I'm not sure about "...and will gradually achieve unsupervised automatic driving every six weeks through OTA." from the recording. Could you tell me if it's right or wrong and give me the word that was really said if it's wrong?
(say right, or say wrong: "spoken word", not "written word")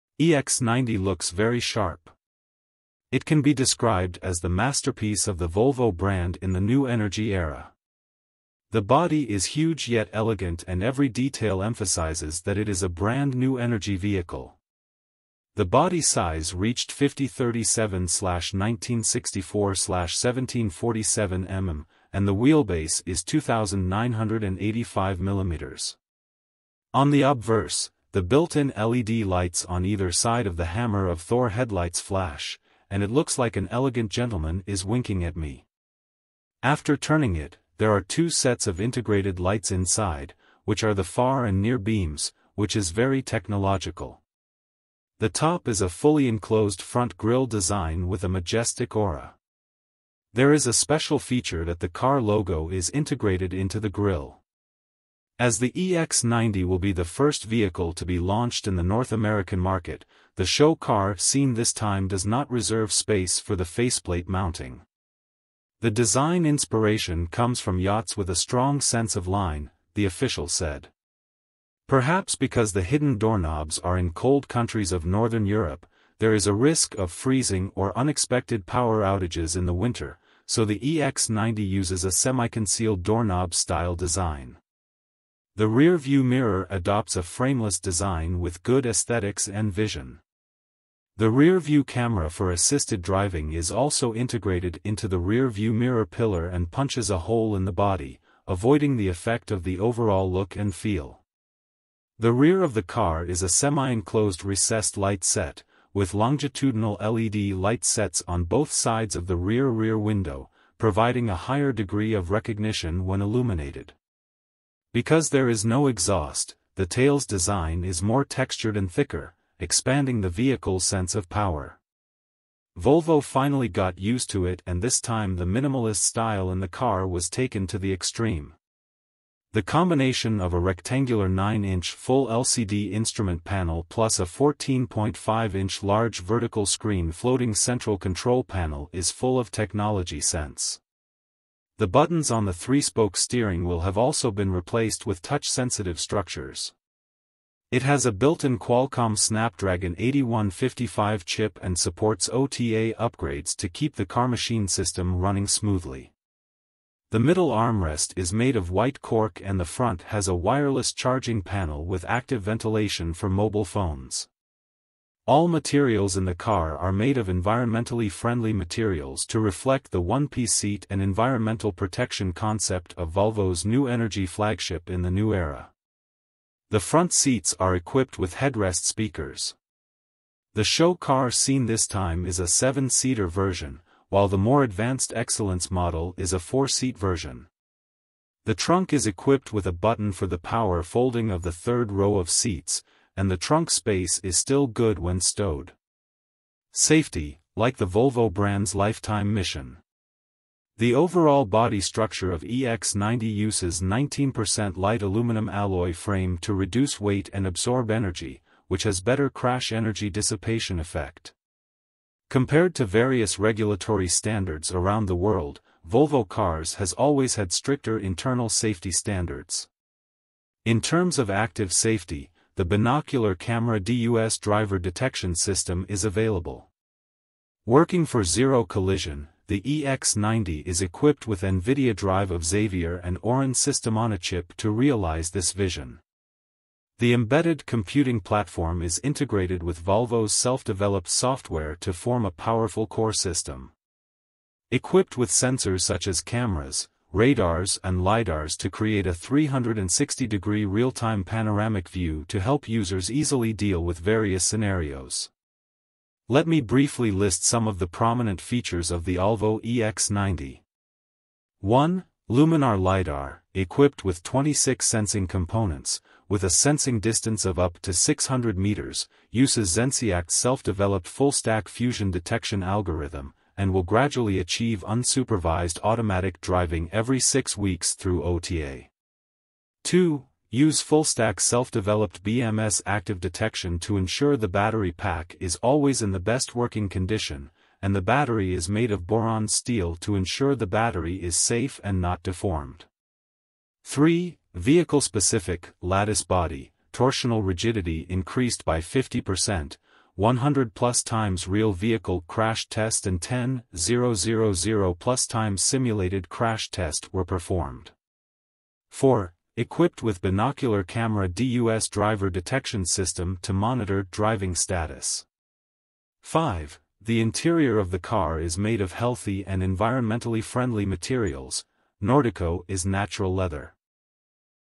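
right.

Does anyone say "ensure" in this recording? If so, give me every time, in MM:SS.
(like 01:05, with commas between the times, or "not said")
04:43, 04:50.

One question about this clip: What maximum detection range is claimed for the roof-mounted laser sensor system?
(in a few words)
600 meters.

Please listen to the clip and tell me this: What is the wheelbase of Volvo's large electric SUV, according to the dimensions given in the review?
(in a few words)
2985 mm.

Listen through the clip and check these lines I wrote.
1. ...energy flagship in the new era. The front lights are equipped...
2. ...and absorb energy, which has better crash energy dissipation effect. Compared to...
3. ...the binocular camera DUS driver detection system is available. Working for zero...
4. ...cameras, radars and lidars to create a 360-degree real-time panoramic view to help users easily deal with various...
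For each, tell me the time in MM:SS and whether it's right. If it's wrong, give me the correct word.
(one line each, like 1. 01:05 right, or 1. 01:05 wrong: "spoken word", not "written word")
1. 02:53 wrong: "seats", not "lights"
2. 03:27 right
3. 03:42 right
4. 04:06 right.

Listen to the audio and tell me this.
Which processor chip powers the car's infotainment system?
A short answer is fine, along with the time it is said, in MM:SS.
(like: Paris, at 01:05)
Snapdragon 8155, at 02:29.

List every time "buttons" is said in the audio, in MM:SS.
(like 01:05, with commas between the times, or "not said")
02:21, 03:09.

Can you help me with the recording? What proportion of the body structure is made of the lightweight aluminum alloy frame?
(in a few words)
19%.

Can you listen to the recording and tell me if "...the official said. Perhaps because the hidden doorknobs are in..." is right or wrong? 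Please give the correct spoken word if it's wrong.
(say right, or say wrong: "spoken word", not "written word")
right.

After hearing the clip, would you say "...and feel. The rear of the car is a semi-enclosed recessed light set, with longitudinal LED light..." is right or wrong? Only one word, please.
right.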